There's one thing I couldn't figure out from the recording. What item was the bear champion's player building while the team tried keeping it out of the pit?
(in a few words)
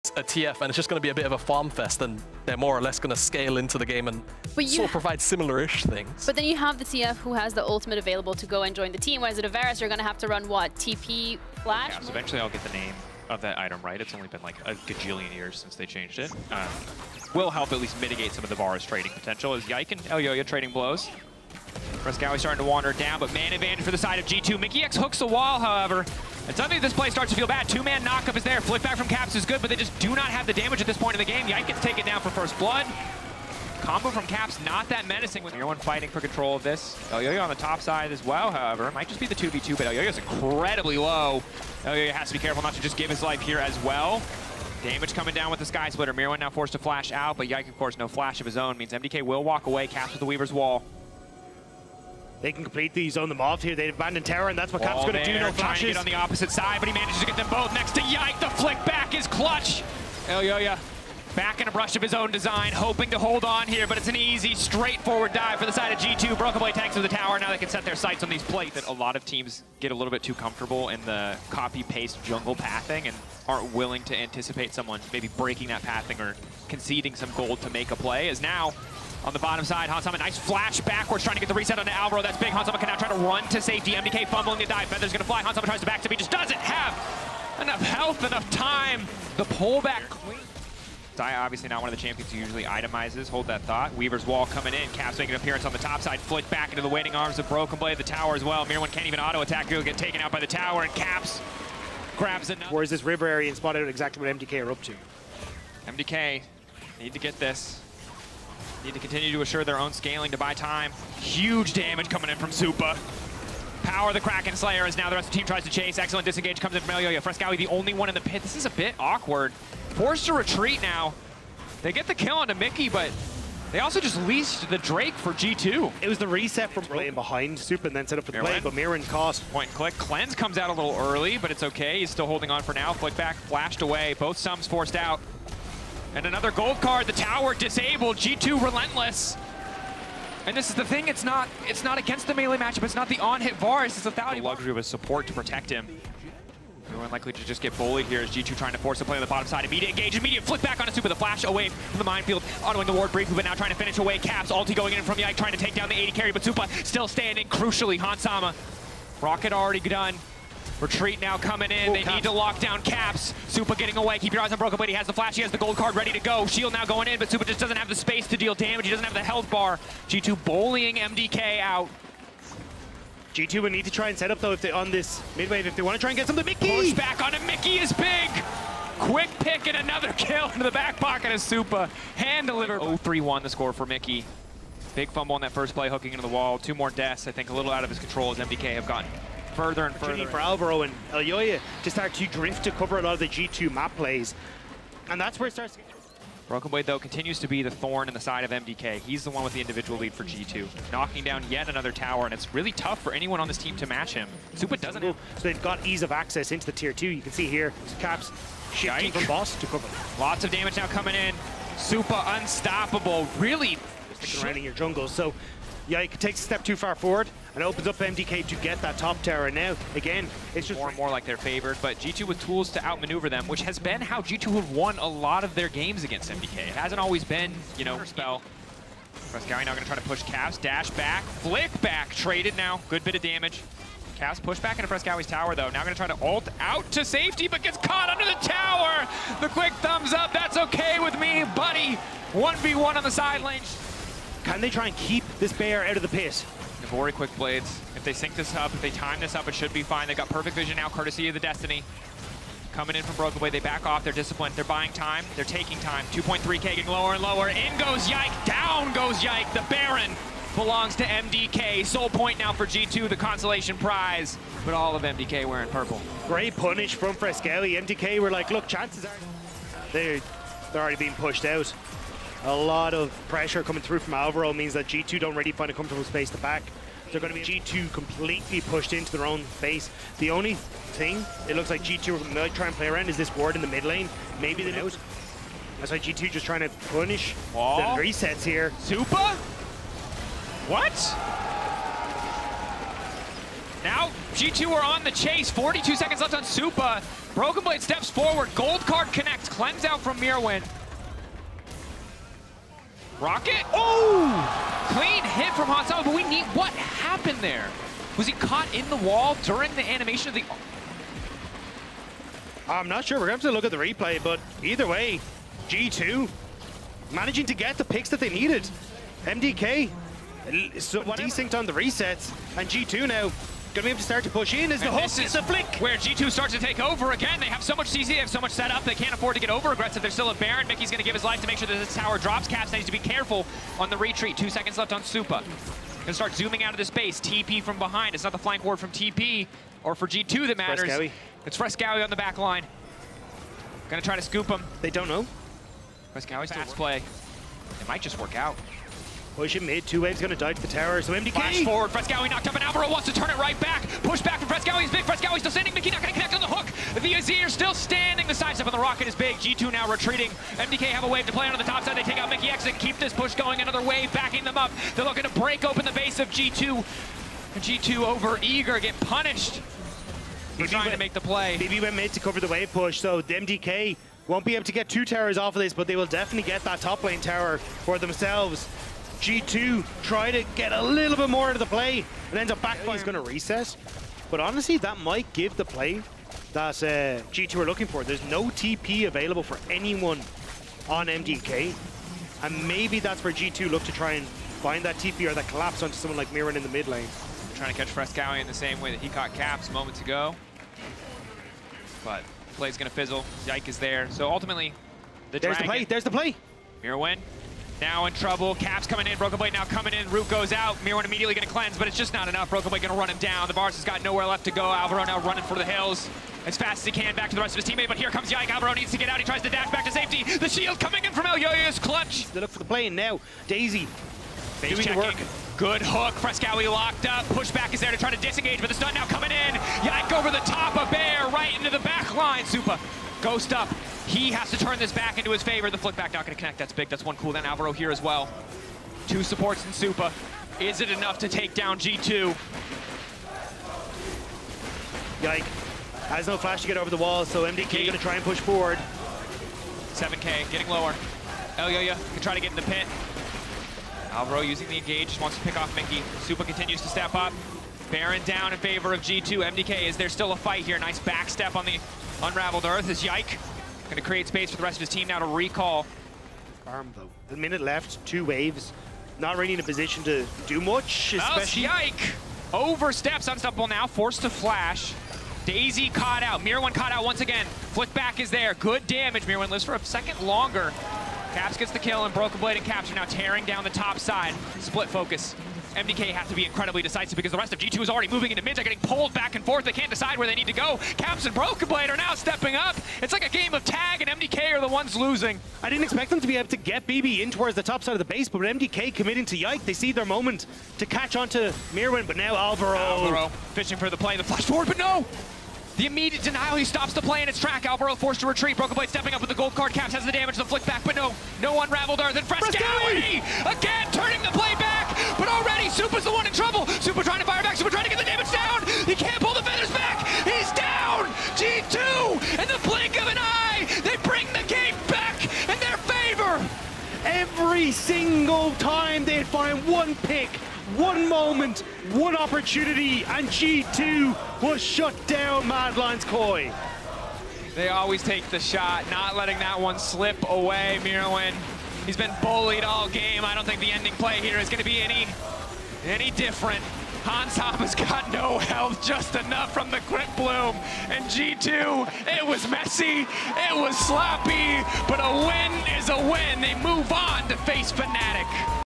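Navori Quick Blades.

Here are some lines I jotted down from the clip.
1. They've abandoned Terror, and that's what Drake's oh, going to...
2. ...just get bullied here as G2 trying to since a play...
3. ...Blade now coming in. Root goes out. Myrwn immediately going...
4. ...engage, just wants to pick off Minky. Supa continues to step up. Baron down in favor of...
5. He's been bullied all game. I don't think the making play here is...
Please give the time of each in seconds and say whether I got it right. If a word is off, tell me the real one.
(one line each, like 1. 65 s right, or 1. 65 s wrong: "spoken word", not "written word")
1. 53 s wrong: "Cap", not "Drake"
2. 147 s wrong: "force", not "since"
3. 409 s right
4. 454 s right
5. 541 s wrong: "ending", not "making".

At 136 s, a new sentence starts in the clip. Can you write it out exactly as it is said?
And another gold card, the tower disabled, G2 relentless.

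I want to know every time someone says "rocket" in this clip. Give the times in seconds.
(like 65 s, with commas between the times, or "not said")
159 s, 303 s, 358 s.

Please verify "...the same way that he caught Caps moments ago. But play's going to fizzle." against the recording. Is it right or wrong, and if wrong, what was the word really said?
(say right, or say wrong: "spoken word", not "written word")
right.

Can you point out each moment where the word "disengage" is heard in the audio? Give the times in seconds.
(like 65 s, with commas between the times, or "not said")
116 s, 428 s.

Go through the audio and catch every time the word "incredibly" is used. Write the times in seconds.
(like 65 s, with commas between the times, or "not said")
40 s, 486 s.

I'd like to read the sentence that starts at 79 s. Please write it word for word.
Hans Sama, nice flash backwards, trying to get the reset on the Alvaro.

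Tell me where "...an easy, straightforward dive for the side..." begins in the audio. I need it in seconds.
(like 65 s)
64 s.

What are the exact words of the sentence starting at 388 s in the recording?
There's no TP available for anyone on MDK.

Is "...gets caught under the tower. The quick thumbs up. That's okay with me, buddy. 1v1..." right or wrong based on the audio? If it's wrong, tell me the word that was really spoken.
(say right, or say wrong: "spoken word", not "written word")
right.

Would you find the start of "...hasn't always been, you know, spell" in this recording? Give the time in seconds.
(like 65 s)
226 s.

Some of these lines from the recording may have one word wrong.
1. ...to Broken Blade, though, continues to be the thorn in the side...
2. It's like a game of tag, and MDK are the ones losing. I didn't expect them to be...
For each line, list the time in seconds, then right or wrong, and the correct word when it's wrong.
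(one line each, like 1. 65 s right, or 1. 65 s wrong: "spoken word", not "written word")
1. 195 s right
2. 493 s right.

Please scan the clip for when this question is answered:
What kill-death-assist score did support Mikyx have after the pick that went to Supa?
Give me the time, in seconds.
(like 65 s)
182 s.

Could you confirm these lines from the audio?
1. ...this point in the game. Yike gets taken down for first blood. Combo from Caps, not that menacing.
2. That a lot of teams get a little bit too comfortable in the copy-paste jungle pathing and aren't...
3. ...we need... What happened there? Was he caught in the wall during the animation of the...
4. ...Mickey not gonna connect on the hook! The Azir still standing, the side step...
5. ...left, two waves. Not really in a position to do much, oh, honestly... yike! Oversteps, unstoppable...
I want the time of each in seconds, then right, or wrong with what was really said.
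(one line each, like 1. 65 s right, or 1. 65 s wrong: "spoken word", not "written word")
1. 30 s right
2. 68 s right
3. 306 s right
4. 355 s right
5. 467 s wrong: "especially", not "honestly".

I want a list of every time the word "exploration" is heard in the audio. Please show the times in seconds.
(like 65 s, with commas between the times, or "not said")
not said.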